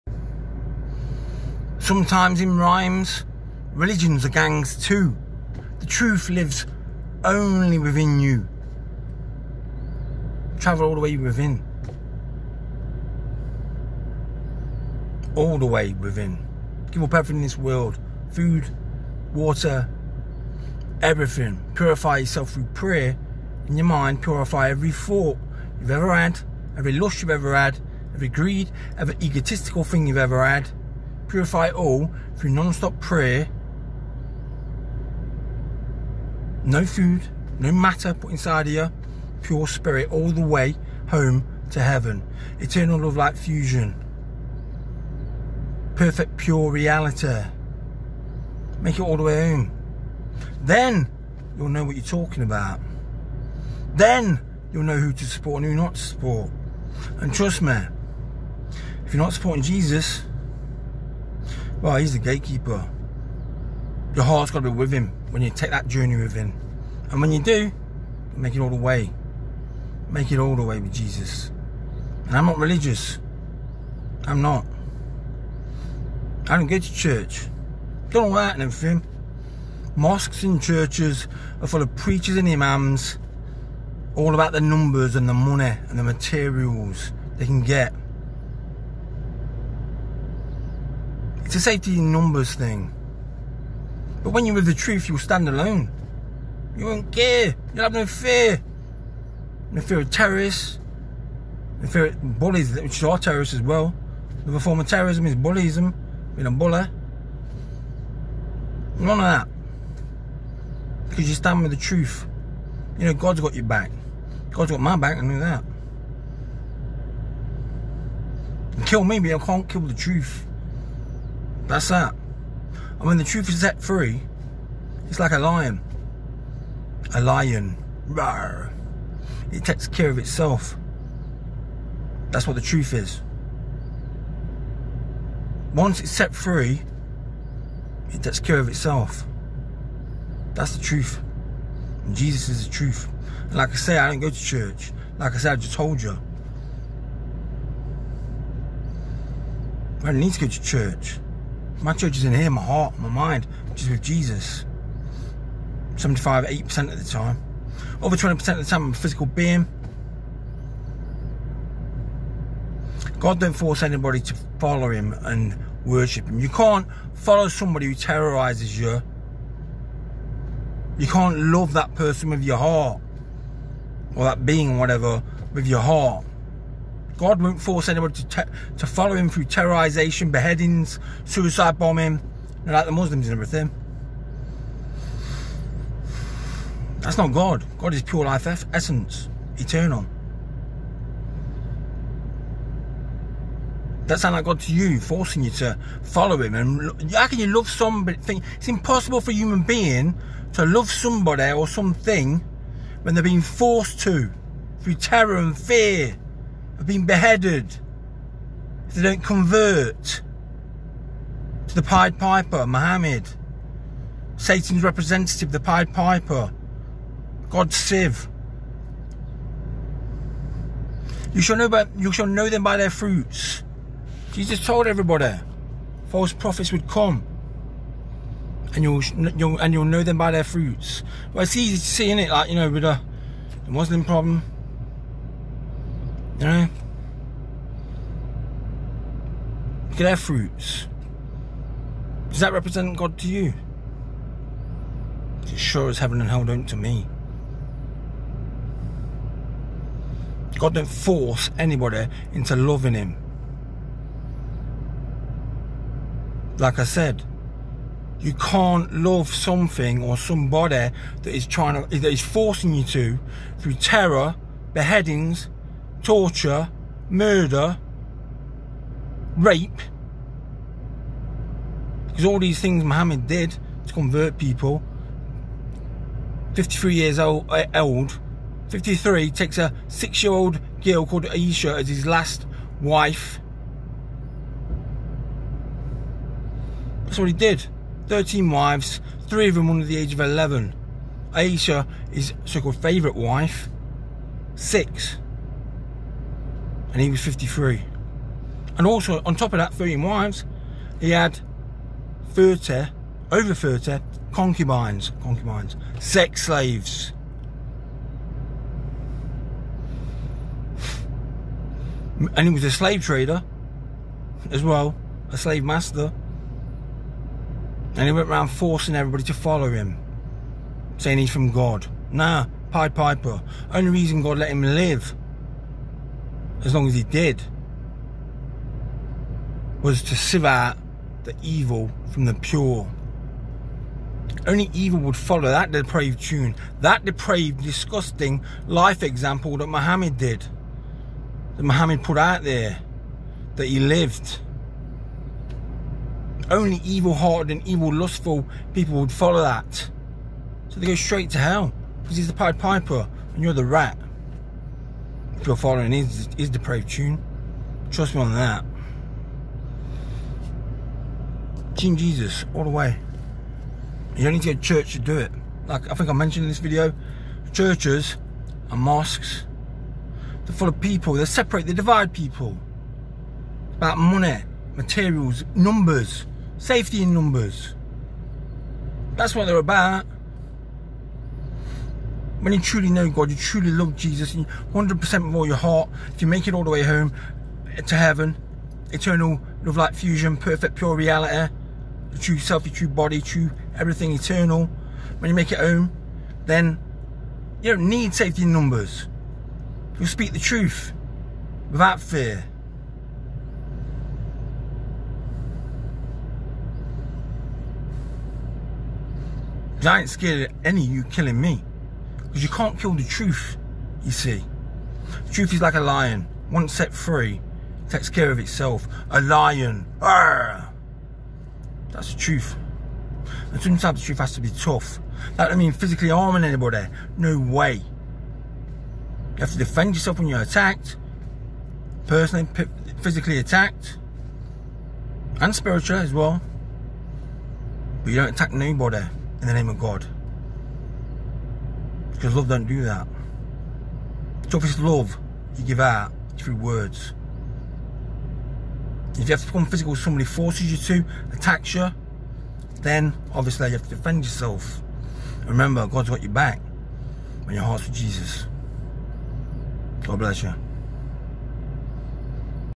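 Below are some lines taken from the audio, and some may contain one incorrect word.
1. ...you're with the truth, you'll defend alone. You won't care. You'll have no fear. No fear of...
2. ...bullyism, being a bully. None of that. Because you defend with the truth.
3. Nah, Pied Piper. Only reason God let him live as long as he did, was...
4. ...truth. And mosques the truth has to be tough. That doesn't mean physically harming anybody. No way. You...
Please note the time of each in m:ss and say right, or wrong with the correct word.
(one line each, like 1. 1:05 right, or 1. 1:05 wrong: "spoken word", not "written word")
1. 1:34 wrong: "stand", not "defend"
2. 1:45 wrong: "stand", not "defend"
3. 5:22 right
4. 7:02 wrong: "sometimes", not "mosques".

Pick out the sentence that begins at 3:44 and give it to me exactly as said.
Jesus told everybody, false prophets would come, and you'll, you'll and you'll know them by their fruits.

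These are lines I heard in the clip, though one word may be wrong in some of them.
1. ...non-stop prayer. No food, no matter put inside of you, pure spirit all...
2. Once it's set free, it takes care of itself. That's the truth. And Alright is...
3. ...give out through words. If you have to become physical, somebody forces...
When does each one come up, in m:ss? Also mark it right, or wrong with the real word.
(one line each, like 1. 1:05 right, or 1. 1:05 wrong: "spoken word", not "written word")
1. 0:32 right
2. 2:15 wrong: "Jesus", not "Alright"
3. 7:25 right.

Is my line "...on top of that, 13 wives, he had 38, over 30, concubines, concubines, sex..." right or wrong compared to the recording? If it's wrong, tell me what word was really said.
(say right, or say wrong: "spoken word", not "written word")
wrong: "30", not "38".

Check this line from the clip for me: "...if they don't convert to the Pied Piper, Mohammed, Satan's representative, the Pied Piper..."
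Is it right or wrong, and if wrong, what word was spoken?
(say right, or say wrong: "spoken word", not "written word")
right.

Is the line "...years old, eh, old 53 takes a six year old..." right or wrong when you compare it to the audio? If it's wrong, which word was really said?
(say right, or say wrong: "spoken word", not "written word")
right.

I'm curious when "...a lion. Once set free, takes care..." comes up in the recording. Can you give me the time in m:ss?
6:55.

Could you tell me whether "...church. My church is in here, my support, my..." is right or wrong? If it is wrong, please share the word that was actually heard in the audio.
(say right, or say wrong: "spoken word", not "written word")
wrong: "heart", not "support".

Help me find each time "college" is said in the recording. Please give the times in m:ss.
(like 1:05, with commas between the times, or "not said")
not said.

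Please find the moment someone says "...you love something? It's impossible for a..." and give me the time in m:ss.
3:17.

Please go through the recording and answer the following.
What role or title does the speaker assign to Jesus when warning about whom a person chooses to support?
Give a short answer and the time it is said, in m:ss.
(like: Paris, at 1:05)
the gatekeeper, at 1:02.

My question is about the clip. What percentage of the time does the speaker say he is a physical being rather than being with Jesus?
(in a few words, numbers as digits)
20%.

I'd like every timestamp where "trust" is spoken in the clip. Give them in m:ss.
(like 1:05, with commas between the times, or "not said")
0:57, 5:57.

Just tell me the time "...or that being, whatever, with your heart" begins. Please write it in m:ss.
2:54.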